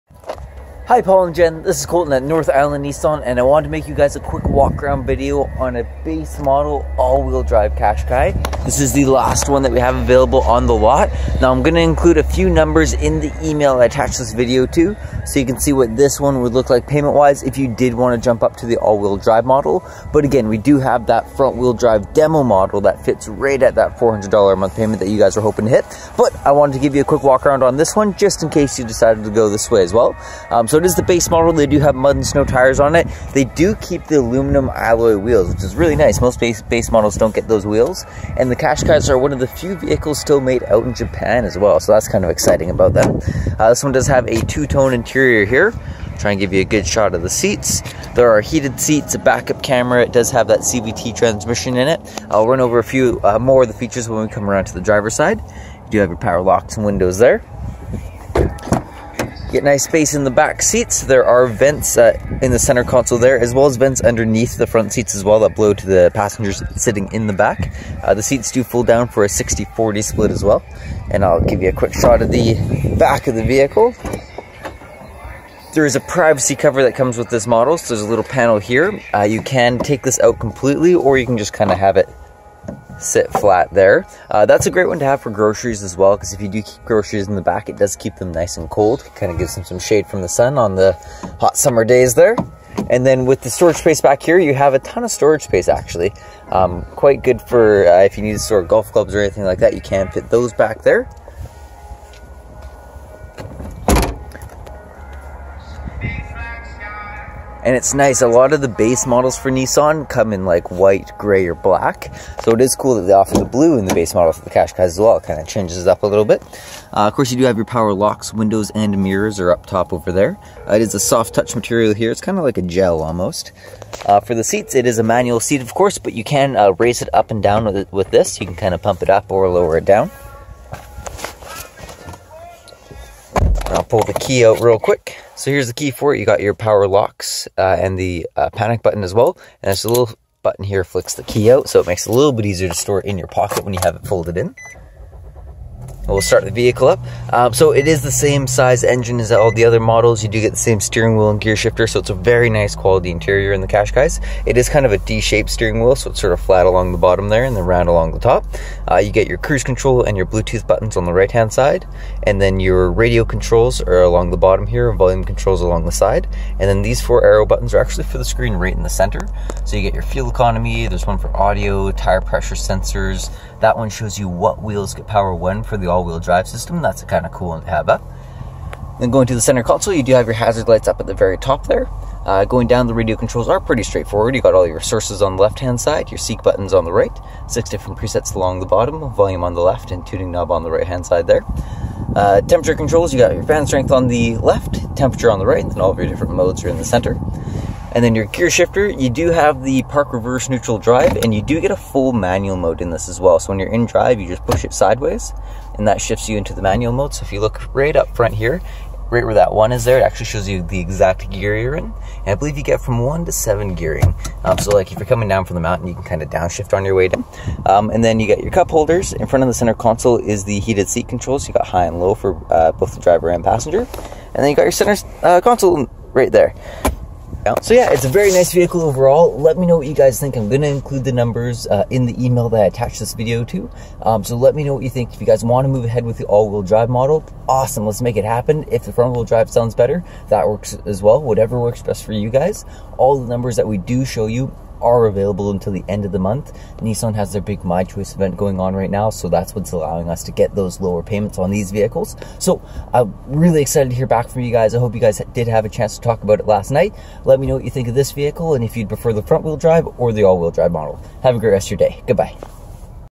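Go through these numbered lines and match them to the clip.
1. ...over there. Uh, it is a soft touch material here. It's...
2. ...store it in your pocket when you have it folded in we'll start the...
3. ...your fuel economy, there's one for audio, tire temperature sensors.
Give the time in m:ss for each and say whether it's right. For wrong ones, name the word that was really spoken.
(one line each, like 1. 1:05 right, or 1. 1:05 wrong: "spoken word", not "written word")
1. 1:59 right
2. 2:22 right
3. 2:49 wrong: "pressure", not "temperature".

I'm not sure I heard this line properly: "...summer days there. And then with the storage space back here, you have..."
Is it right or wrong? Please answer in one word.
right.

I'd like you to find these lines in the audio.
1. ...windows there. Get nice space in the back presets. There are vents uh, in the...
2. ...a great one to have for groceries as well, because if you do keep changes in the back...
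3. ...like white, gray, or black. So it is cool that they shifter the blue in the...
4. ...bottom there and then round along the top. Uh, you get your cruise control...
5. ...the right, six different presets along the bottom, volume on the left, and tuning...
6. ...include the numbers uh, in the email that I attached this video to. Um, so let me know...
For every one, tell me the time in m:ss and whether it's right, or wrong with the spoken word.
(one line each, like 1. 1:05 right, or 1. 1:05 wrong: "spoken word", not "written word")
1. 0:56 wrong: "seats", not "presets"
2. 1:24 wrong: "groceries", not "changes"
3. 1:50 wrong: "offer", not "shifter"
4. 2:36 right
5. 3:06 right
6. 3:50 right.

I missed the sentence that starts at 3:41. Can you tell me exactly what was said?
You got high and low for uh, both the driver and passenger.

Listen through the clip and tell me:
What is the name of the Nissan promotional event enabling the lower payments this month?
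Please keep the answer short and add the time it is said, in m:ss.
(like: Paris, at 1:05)
My Choice, at 4:07.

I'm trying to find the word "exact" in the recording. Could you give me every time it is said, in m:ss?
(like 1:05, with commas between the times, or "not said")
3:30.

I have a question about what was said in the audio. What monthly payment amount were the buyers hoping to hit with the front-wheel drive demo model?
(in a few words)
$400.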